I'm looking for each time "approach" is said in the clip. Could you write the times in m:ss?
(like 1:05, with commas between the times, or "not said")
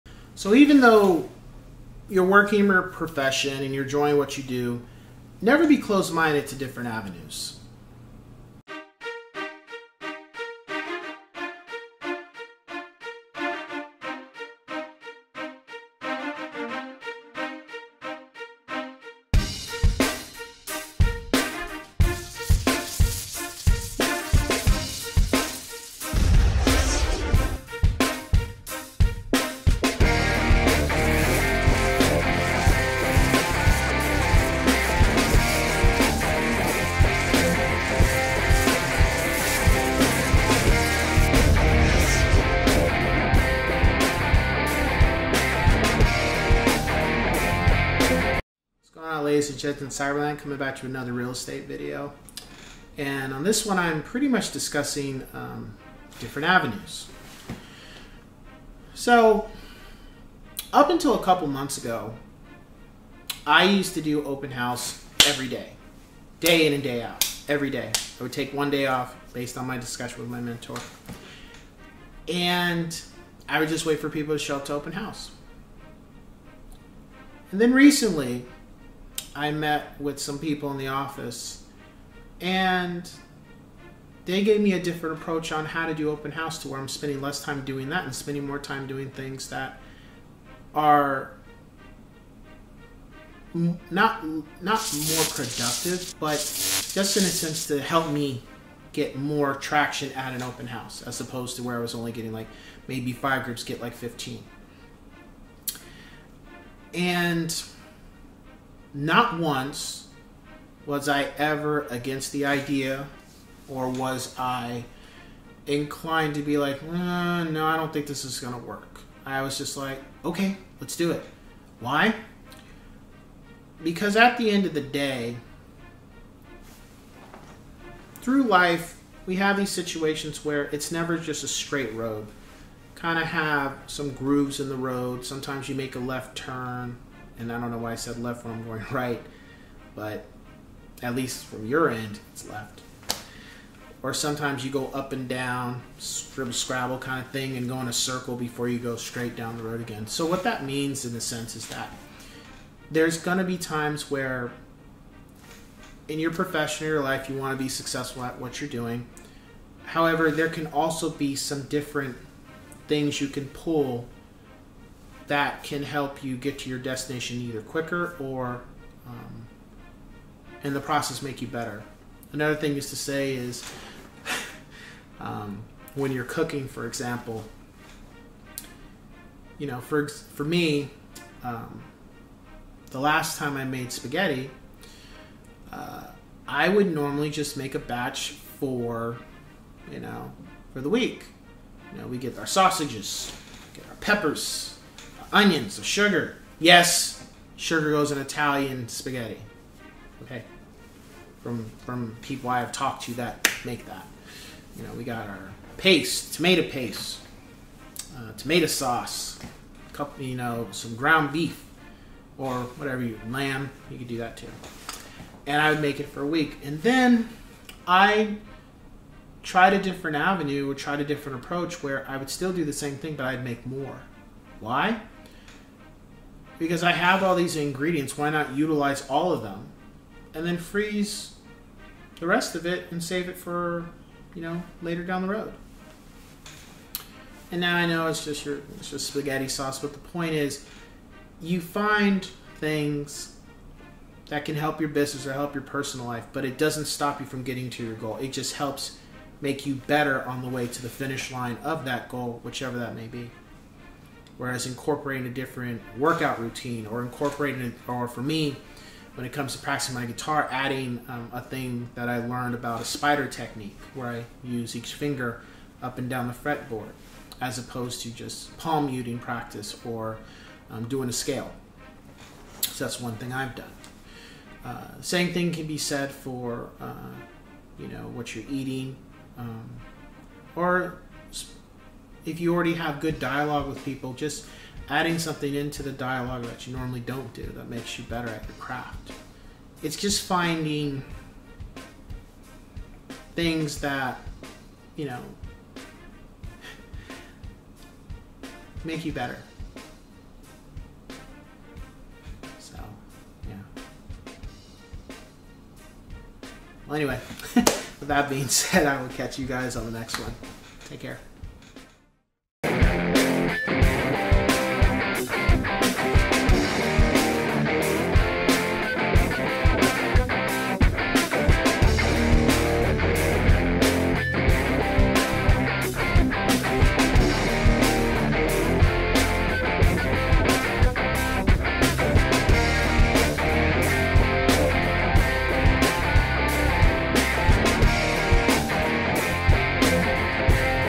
1:25, 3:41.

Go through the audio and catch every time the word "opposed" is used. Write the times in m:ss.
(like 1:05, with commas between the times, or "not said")
1:41, 4:27.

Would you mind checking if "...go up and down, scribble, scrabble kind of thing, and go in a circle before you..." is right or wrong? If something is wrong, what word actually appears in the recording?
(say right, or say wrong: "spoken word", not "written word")
right.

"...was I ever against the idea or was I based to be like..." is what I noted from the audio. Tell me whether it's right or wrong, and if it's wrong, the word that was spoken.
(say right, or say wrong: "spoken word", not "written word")
wrong: "inclined", not "based".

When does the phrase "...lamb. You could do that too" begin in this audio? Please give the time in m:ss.
3:33.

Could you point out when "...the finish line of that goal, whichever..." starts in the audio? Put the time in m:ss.
4:10.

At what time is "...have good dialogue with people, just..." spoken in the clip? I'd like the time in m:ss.
4:42.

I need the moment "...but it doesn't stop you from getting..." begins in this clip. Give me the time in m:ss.
4:06.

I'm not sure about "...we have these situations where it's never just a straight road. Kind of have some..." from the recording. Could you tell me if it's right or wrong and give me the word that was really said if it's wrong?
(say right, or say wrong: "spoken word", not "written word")
right.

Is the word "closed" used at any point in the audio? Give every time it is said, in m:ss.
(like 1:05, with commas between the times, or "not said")
0:05.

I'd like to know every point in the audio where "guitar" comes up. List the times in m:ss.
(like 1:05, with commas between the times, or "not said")
4:20.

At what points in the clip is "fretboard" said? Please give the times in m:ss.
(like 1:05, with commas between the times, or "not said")
4:26.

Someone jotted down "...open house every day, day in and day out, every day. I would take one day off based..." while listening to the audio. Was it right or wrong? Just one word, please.
right.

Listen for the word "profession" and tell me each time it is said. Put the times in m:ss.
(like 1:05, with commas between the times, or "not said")
0:02, 2:36.